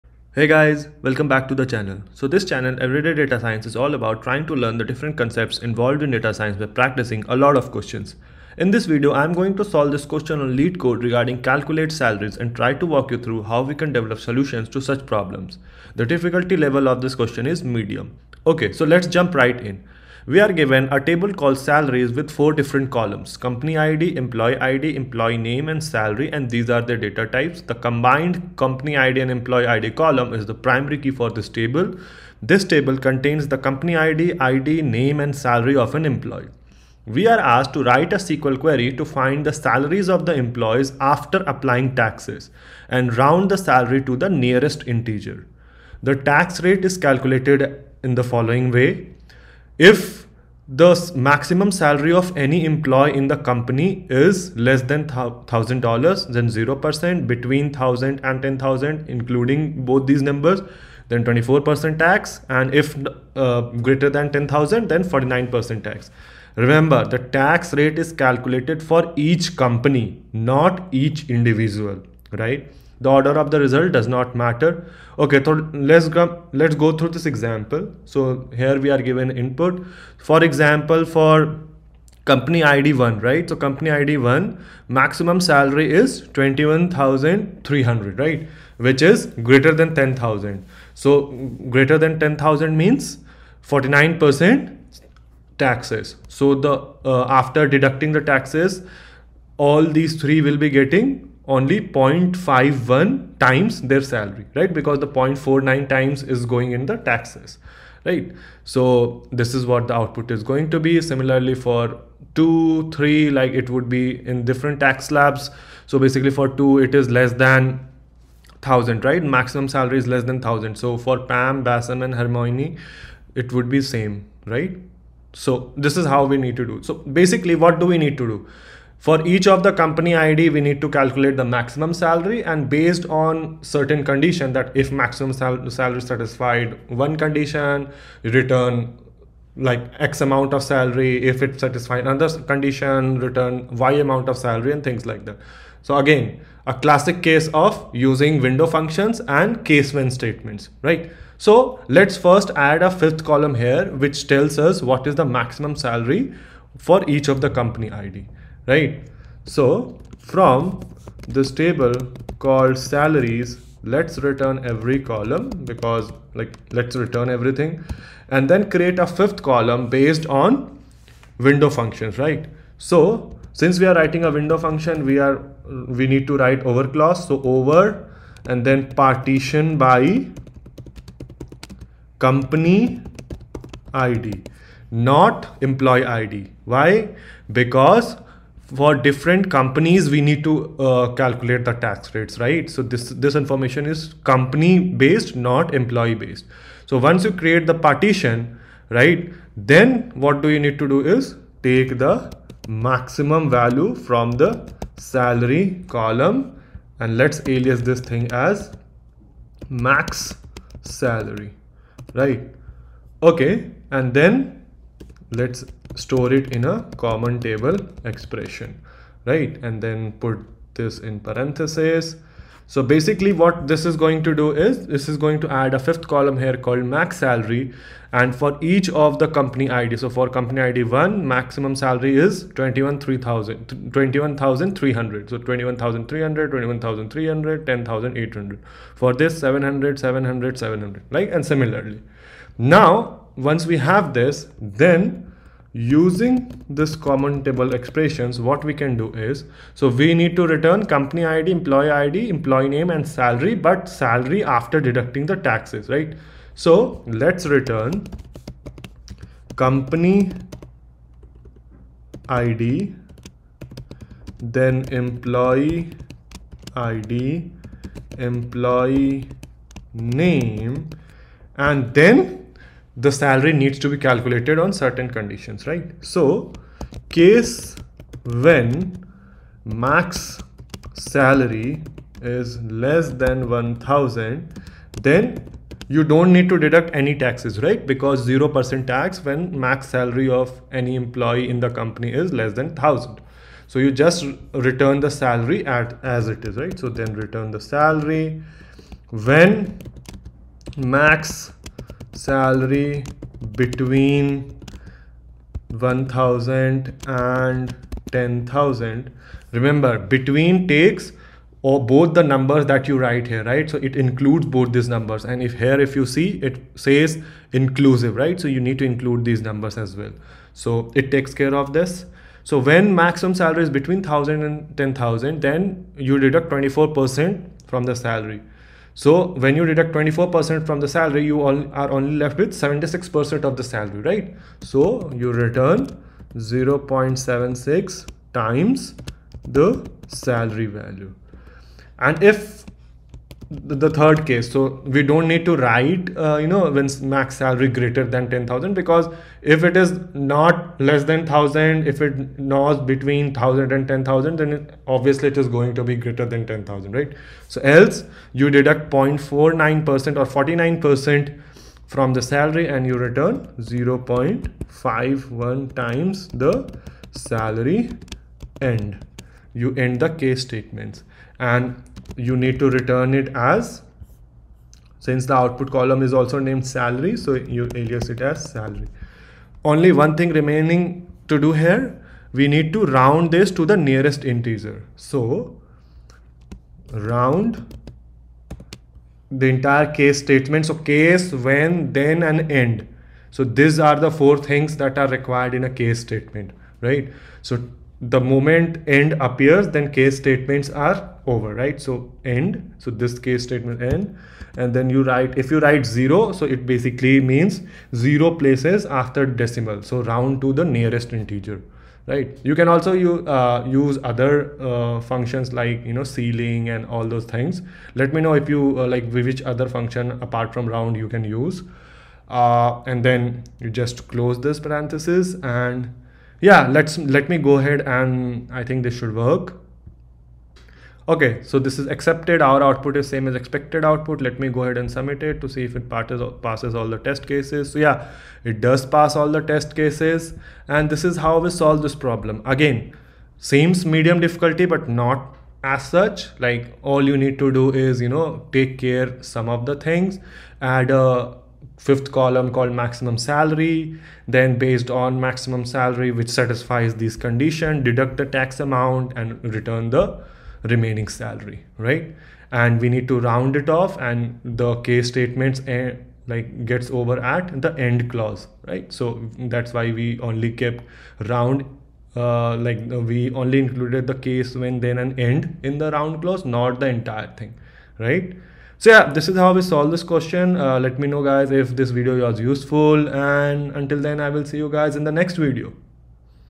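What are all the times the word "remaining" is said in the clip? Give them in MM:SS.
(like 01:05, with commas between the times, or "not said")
06:20, 07:40.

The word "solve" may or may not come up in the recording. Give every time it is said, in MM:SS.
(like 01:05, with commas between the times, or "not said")
00:09, 07:21, 07:59.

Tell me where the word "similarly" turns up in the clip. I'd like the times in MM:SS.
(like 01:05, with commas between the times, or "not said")
01:51, 04:01.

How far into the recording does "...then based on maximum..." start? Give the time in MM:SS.
07:34.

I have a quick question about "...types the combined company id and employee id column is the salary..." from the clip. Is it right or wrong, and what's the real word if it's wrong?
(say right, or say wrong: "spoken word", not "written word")
wrong: "primary", not "salary".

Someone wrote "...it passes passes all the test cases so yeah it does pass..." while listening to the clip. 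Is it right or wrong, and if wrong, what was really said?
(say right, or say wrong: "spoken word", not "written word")
right.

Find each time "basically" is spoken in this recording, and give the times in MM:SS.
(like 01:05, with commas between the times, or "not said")
01:55, 02:07, 03:42, 06:46.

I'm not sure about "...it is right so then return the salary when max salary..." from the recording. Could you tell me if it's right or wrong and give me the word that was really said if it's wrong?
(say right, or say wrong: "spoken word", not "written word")
right.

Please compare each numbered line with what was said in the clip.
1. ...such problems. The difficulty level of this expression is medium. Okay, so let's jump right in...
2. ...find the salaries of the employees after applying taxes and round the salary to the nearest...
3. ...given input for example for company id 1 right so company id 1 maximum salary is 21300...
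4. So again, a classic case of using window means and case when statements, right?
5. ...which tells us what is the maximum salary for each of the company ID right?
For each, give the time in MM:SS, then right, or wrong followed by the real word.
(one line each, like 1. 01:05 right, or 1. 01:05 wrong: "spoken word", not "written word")
1. 00:14 wrong: "question", not "expression"
2. 00:39 right
3. 01:19 right
4. 02:25 wrong: "functions", not "means"
5. 02:34 right.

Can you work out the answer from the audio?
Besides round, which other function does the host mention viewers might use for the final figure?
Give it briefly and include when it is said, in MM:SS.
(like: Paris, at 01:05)
ceiling, at 06:56.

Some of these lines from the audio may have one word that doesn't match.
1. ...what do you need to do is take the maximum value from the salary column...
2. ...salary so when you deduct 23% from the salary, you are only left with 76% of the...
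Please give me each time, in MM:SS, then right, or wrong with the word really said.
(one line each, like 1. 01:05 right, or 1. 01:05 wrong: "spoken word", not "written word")
1. 03:20 right
2. 05:27 wrong: "24", not "23".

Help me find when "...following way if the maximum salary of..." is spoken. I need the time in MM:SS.
00:48.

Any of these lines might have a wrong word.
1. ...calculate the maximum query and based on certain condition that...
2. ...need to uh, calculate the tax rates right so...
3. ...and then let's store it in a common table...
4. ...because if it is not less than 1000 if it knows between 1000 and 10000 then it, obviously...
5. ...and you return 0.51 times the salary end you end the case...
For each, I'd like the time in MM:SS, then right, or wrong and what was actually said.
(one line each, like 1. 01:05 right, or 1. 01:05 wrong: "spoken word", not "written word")
1. 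02:10 wrong: "salary", not "query"
2. 03:10 right
3. 03:33 right
4. 05:48 right
5. 06:02 right.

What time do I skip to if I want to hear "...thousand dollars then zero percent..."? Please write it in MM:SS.
00:55.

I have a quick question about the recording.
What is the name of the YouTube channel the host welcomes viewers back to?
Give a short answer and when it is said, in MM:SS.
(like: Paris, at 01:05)
Everyday Data Science, at 00:02.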